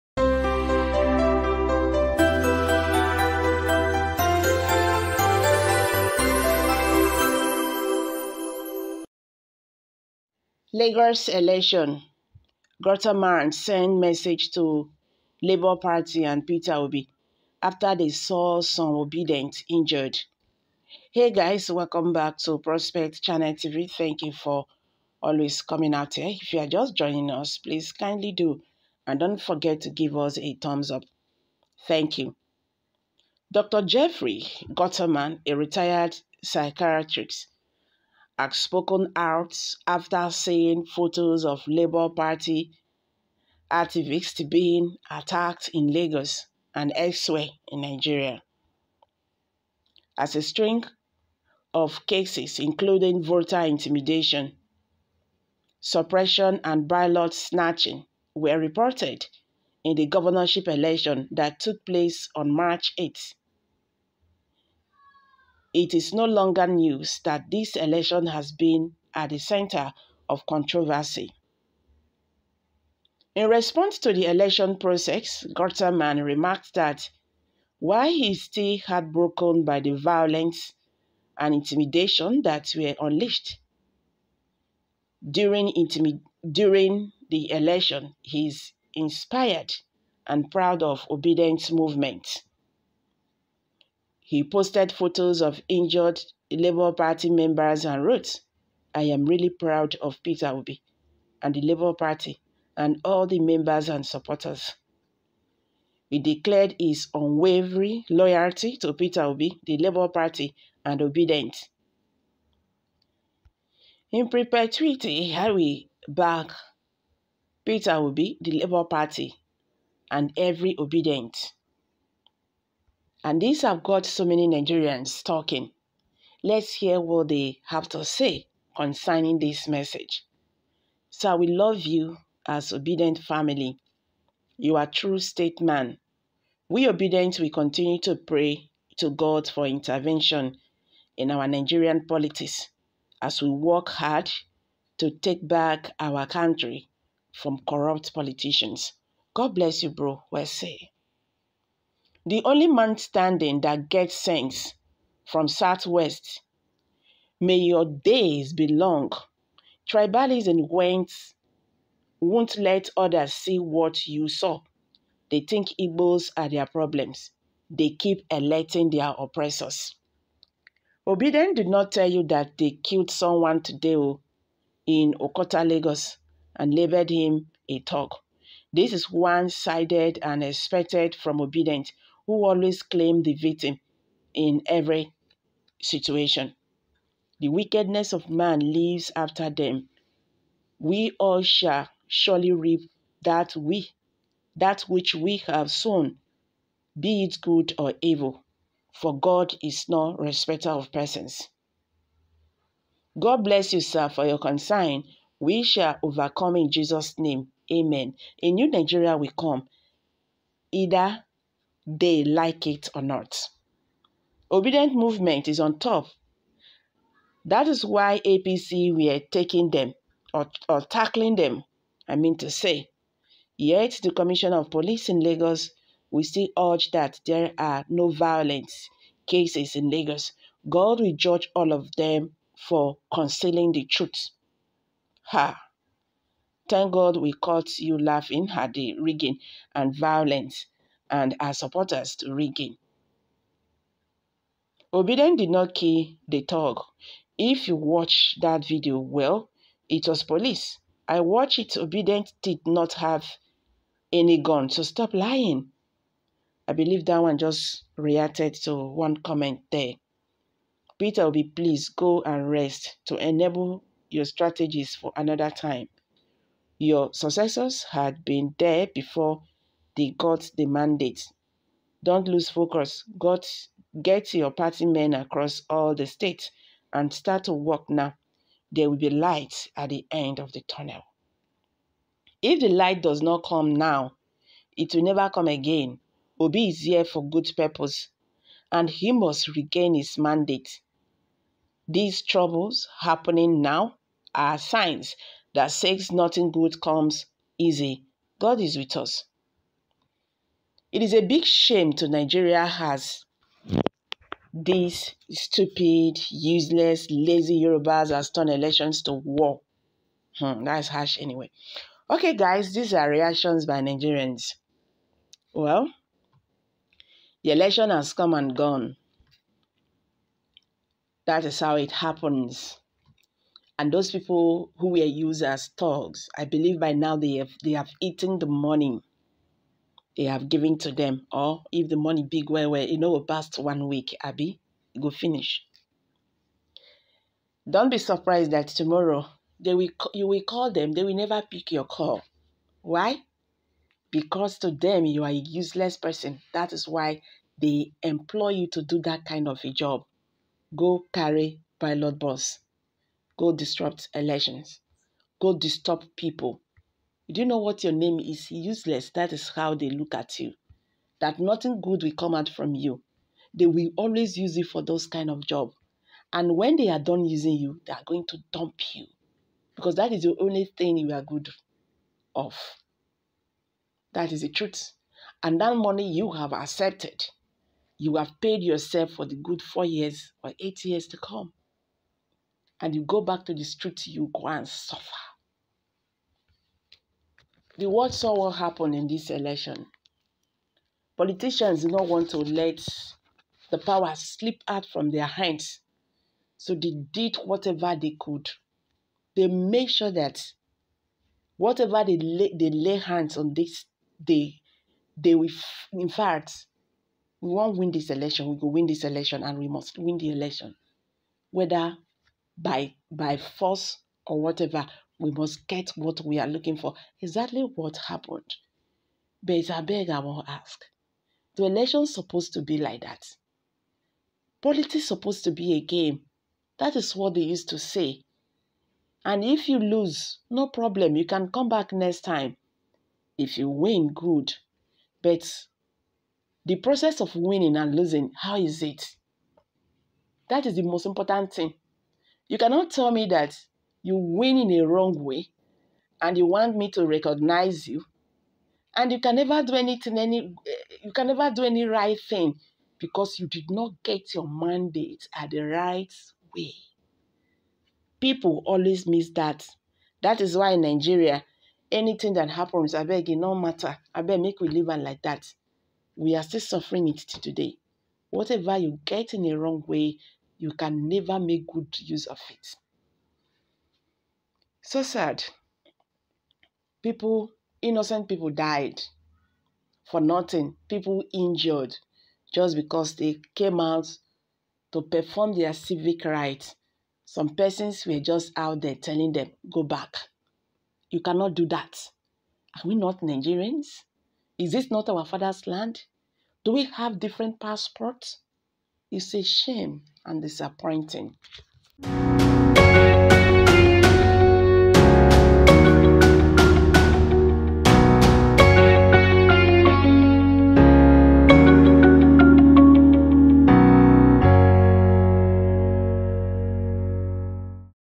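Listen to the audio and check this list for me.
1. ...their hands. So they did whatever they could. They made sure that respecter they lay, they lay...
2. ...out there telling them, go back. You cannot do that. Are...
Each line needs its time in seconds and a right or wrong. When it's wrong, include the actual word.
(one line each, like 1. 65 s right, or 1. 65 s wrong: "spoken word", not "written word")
1. 395 s wrong: "whatever", not "respecter"
2. 488 s right.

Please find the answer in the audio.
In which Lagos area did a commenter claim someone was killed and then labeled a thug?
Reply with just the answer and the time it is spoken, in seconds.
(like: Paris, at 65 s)
Okota, at 175 s.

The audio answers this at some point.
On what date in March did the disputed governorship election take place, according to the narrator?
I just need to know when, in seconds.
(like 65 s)
62 s.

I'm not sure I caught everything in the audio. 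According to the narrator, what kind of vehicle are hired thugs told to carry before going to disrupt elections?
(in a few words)
pilot bus.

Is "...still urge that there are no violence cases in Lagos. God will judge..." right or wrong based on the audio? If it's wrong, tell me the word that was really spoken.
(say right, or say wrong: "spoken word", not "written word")
right.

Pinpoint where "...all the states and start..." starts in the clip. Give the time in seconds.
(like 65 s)
275 s.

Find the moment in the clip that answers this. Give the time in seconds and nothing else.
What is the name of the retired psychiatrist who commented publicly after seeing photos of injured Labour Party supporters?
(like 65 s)
33 s.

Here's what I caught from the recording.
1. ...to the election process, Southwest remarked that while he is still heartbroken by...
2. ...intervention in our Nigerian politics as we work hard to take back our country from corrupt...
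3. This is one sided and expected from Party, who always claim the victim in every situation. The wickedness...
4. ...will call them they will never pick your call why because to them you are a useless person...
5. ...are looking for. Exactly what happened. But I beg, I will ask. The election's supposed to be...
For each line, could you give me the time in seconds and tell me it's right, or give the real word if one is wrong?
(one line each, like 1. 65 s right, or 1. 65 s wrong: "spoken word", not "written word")
1. 73 s wrong: "Guterman", not "Southwest"
2. 139 s right
3. 178 s wrong: "Obidient", not "Party"
4. 340 s right
5. 416 s right.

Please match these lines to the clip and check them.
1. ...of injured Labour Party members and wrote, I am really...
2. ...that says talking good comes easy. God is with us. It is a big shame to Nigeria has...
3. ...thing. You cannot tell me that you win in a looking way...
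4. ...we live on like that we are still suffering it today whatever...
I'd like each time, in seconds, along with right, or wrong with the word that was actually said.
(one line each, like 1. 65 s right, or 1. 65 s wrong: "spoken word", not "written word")
1. 95 s right
2. 295 s wrong: "nothing", not "talking"
3. 441 s wrong: "wrong", not "looking"
4. 464 s right.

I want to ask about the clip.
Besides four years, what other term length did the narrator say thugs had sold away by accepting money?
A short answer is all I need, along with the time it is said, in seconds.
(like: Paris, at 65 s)
8 years, at 380 s.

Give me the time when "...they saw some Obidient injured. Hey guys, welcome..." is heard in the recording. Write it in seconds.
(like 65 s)
17 s.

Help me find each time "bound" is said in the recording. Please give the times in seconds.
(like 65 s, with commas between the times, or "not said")
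not said.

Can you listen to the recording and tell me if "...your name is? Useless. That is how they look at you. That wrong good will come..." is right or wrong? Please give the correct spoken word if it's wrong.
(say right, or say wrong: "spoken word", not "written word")
wrong: "nothing", not "wrong".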